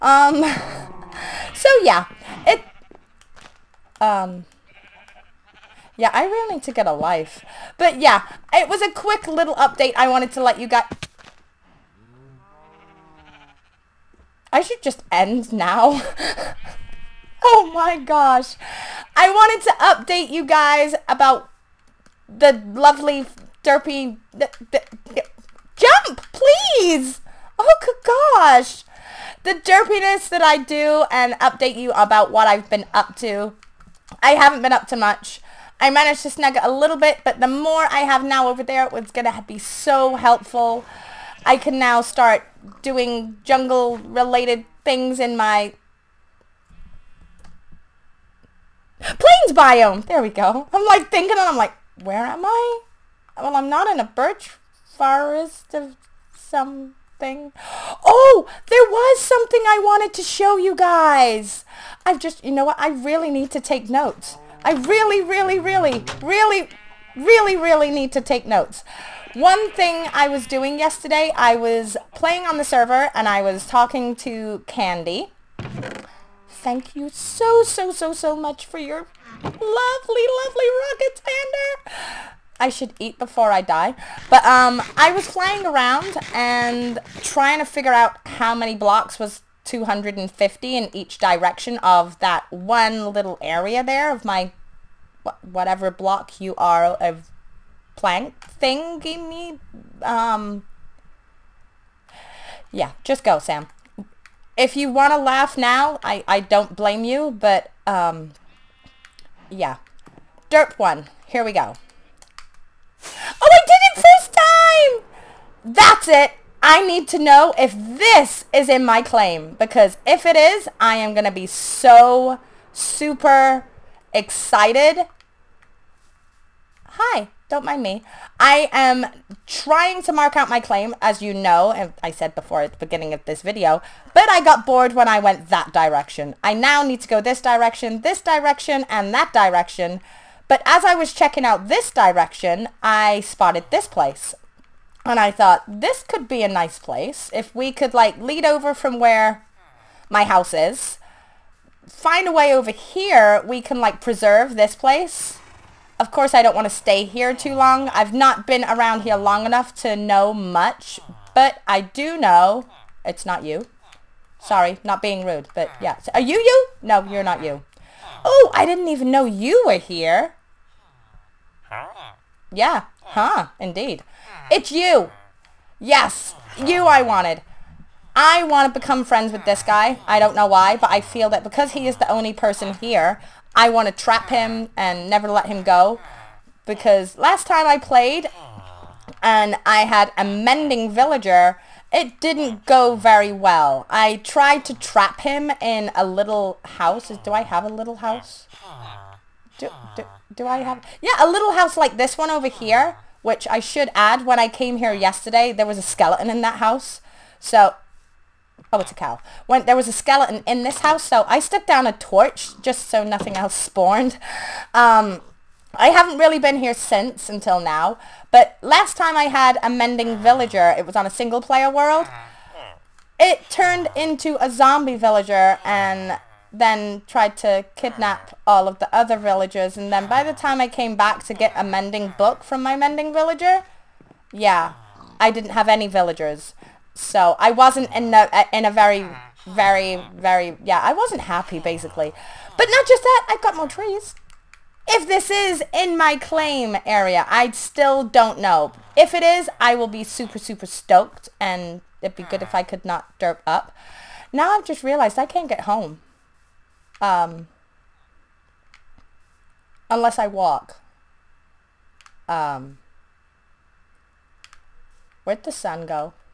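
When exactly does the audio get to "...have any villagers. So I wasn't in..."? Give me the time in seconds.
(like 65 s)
235 s.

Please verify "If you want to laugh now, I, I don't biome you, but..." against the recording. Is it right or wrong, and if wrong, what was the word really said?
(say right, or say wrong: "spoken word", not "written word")
wrong: "blame", not "biome".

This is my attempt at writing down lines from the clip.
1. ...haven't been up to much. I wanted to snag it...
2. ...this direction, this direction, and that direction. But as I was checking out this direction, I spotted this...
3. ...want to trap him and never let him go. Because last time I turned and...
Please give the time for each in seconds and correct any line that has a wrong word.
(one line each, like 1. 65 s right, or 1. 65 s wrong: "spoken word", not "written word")
1. 34 s wrong: "managed", not "wanted"
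2. 137 s right
3. 183 s wrong: "played", not "turned".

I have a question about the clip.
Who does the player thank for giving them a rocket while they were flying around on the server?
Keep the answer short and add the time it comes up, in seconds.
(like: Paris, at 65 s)
Xander, at 81 s.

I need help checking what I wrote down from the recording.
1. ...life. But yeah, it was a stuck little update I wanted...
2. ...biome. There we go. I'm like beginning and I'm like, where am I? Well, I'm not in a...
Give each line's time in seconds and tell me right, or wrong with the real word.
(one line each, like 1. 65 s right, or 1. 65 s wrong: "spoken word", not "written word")
1. 6 s wrong: "quick", not "stuck"
2. 49 s wrong: "thinking", not "beginning".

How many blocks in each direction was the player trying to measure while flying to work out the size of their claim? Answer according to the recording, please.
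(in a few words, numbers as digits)
250.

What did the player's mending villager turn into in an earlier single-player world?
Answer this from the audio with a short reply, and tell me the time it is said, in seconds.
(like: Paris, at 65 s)
Zombie villager, at 224 s.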